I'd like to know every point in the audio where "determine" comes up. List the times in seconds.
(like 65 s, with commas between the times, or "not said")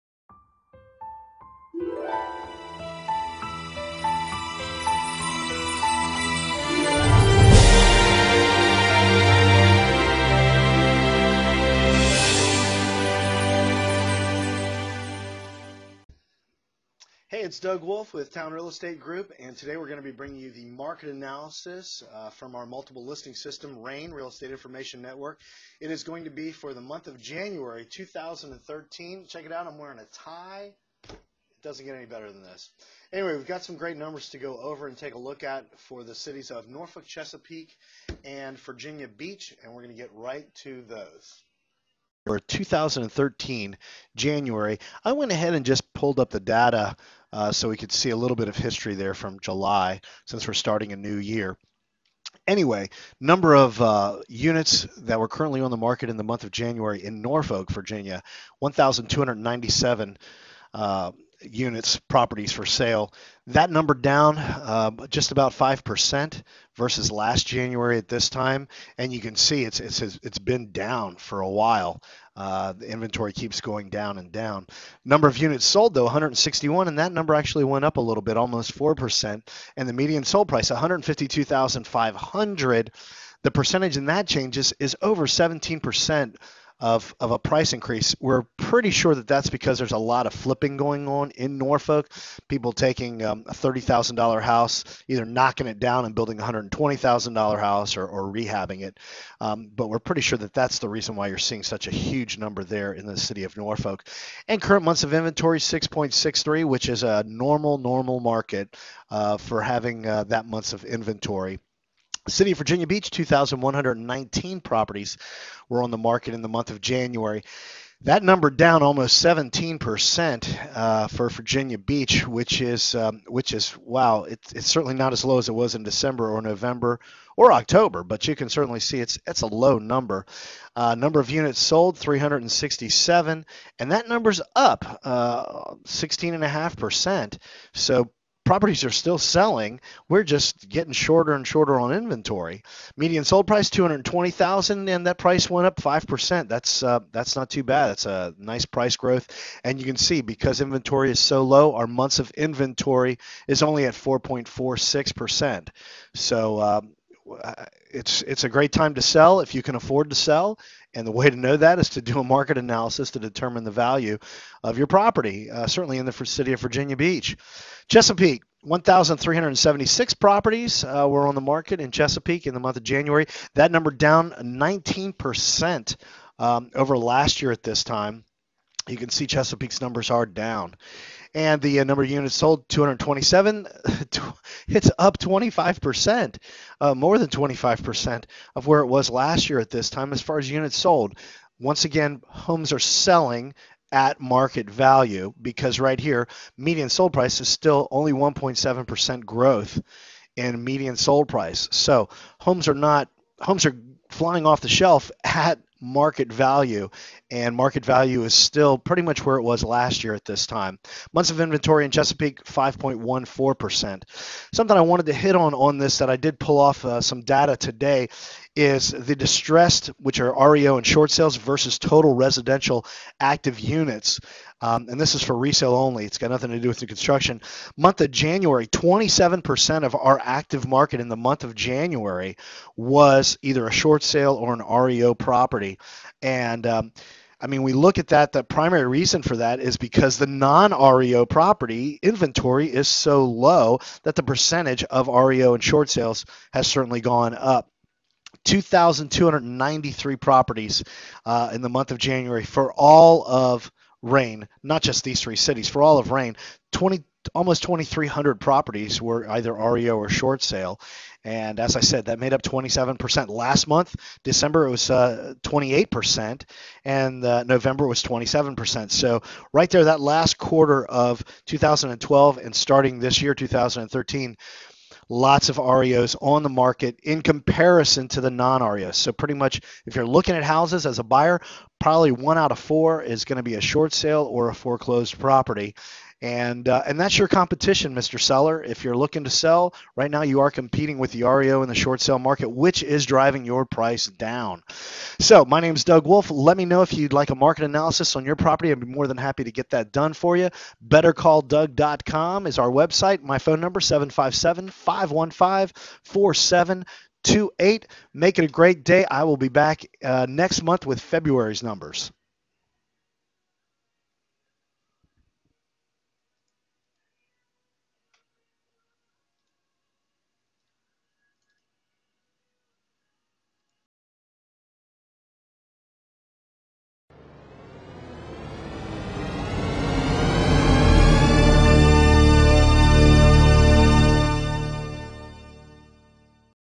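163 s.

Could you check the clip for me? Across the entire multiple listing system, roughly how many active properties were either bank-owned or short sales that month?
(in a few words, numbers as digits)
2,293.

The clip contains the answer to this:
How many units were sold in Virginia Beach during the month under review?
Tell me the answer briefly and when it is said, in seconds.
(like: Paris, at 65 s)
367, at 131 s.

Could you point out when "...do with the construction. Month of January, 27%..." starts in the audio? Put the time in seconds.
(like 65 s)
226 s.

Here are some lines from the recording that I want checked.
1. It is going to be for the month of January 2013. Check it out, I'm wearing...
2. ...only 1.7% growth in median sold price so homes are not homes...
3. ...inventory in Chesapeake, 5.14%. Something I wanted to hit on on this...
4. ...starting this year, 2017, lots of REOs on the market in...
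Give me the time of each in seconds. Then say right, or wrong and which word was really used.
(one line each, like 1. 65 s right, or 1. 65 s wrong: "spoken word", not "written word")
1. 25 s right
2. 197 s right
3. 211 s right
4. 272 s wrong: "2013", not "2017".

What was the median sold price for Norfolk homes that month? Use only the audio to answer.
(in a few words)
152,500.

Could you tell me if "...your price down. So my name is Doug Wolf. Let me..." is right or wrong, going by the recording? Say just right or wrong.
right.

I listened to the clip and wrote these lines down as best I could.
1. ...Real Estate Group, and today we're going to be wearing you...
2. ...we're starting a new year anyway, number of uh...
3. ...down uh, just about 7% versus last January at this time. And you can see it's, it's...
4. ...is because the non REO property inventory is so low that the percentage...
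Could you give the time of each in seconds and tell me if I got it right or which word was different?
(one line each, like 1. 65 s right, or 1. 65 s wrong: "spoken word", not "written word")
1. 18 s wrong: "bringing", not "wearing"
2. 50 s right
3. 63 s wrong: "5", not "7"
4. 239 s right.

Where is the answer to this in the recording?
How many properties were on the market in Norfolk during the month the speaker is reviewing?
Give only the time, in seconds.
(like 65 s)
58 s.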